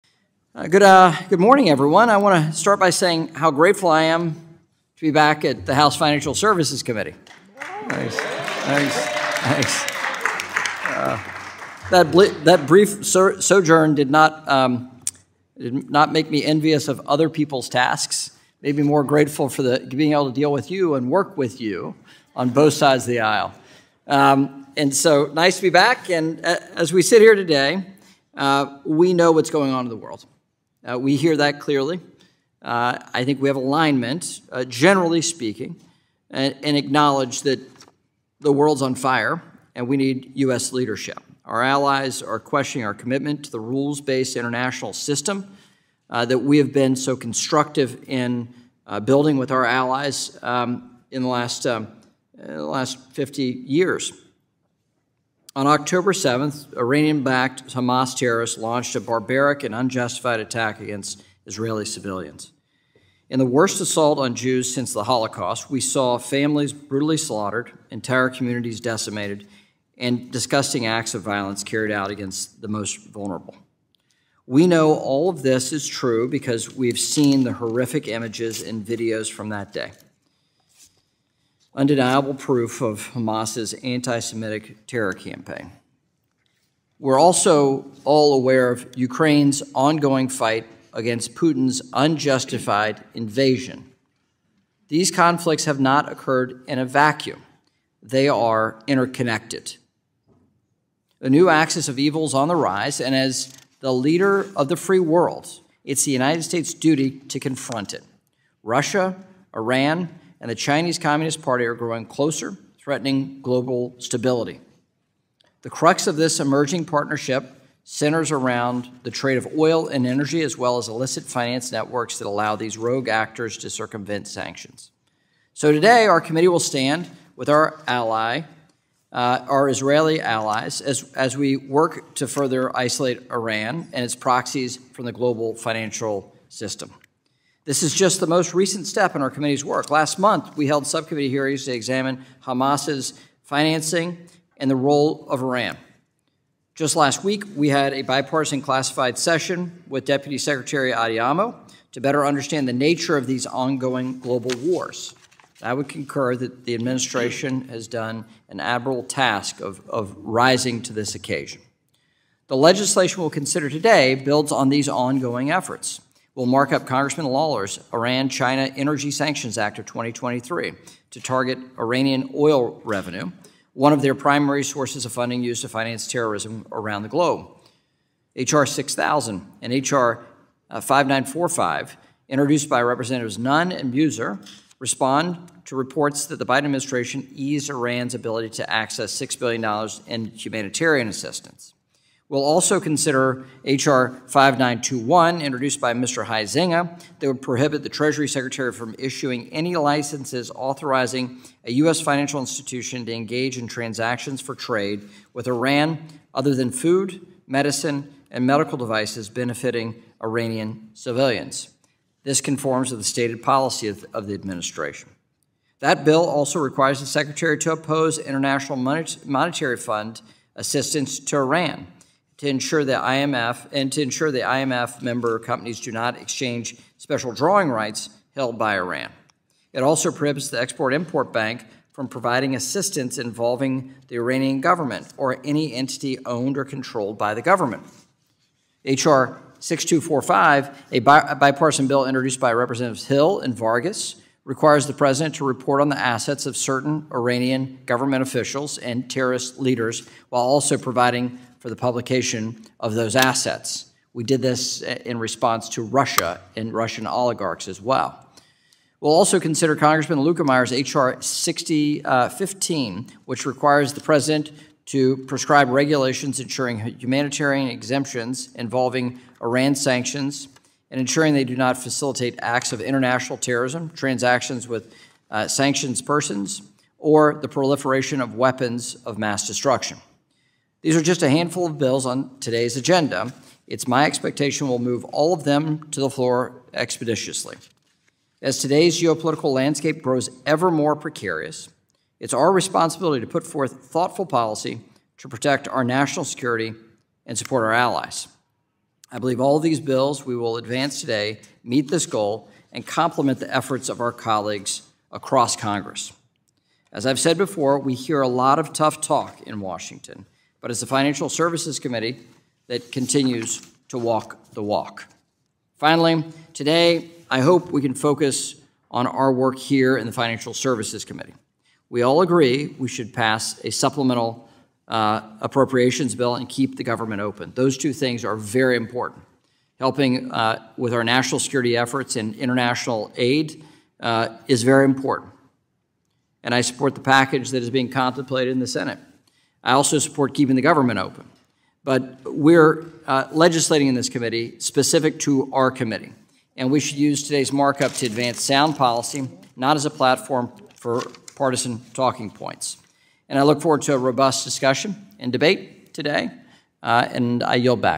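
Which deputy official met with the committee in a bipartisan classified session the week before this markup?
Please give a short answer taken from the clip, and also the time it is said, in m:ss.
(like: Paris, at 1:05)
Deputy Secretary Adeyemo, at 2:30.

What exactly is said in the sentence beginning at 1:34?
These conflicts have not occurred in a vacuum, they are interconnected.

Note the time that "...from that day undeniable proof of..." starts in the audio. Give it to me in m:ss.
1:19.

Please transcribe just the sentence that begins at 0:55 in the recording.
On October 7th, Iranian backed Hamas terrorists launched a barbaric and unjustified attack against Israeli civilians.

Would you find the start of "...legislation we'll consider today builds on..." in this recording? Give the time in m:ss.
2:42.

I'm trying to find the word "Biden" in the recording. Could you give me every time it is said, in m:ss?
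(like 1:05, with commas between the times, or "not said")
3:06.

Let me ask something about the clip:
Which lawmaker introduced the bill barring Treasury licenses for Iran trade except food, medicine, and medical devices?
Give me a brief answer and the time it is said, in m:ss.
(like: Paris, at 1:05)
Mr. Huizenga, at 3:15.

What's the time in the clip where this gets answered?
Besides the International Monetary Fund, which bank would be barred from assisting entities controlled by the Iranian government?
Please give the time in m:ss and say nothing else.
3:50.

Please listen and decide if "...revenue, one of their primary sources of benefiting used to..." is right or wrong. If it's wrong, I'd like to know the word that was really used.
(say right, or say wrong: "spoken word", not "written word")
wrong: "funding", not "benefiting".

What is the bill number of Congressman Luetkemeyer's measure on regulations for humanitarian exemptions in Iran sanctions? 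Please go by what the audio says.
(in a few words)
H.R. 6015.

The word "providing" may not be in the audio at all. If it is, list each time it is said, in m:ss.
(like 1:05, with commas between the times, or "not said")
3:52, 4:10.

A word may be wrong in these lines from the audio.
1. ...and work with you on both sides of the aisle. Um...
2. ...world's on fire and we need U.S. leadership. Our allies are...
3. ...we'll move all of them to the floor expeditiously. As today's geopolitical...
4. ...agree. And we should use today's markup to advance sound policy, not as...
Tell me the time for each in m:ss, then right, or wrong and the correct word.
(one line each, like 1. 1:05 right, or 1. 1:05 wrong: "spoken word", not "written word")
1. 0:20 right
2. 0:38 right
3. 4:44 right
4. 5:45 wrong: "committee", not "agree".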